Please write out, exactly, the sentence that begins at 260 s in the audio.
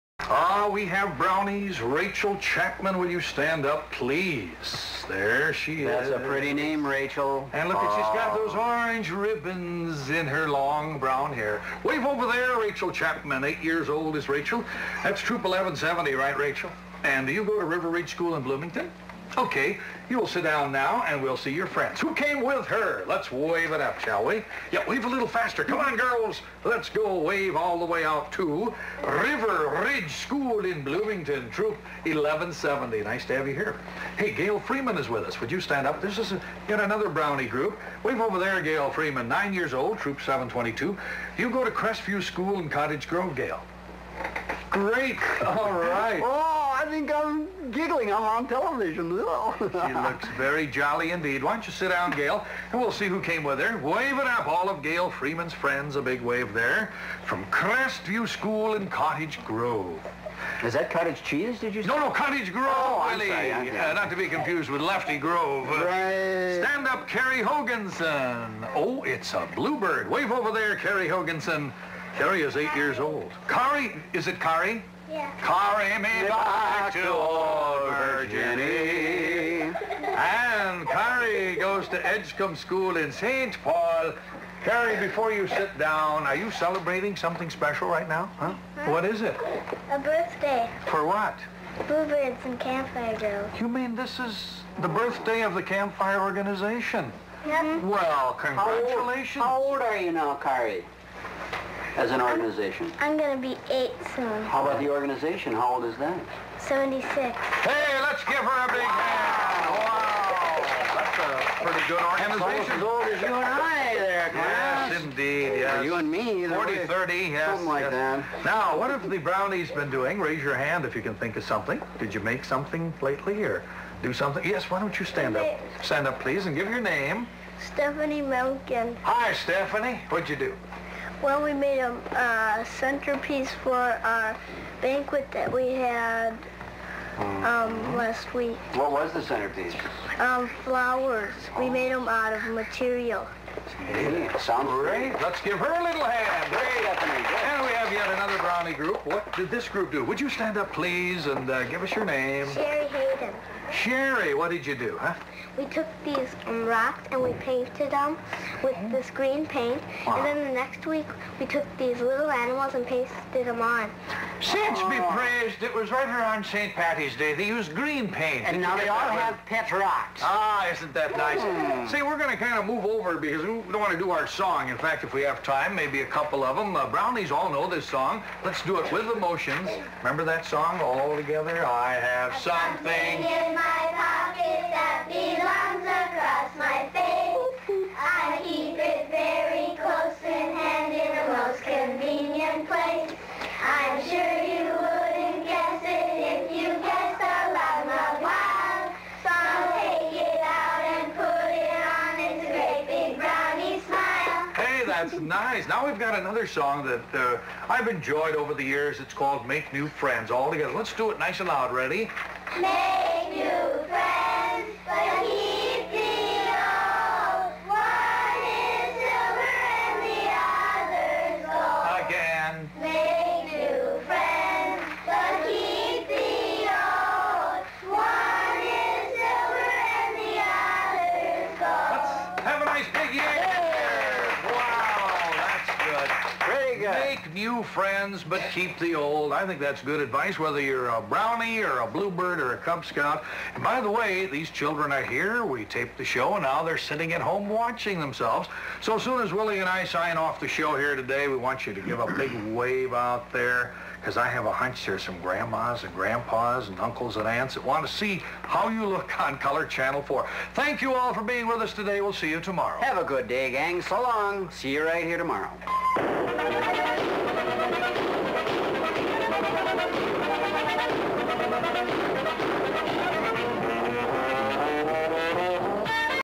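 Thank you all for being with us today.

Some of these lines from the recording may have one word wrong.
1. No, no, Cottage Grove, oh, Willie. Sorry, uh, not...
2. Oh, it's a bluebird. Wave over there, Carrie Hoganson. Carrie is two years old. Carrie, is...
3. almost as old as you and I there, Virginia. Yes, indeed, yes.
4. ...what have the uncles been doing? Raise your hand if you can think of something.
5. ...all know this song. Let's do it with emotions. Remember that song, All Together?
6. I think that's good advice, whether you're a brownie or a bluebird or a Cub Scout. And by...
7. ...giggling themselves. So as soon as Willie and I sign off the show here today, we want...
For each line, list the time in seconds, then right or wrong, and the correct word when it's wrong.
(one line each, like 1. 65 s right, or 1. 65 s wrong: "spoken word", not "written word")
1. 61 s right
2. 68 s wrong: "eight", not "two"
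3. 112 s wrong: "Clarence", not "Virginia"
4. 118 s wrong: "brownies", not "uncles"
5. 177 s right
6. 239 s right
7. 247 s wrong: "watching", not "giggling".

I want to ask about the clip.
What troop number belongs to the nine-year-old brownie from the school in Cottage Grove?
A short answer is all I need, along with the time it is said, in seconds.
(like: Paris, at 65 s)
722, at 39 s.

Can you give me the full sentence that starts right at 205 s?
Now we've got another song that uh, I've enjoyed over the years.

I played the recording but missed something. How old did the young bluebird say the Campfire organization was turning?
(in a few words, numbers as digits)
76.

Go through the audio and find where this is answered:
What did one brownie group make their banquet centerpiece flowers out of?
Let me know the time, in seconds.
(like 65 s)
142 s.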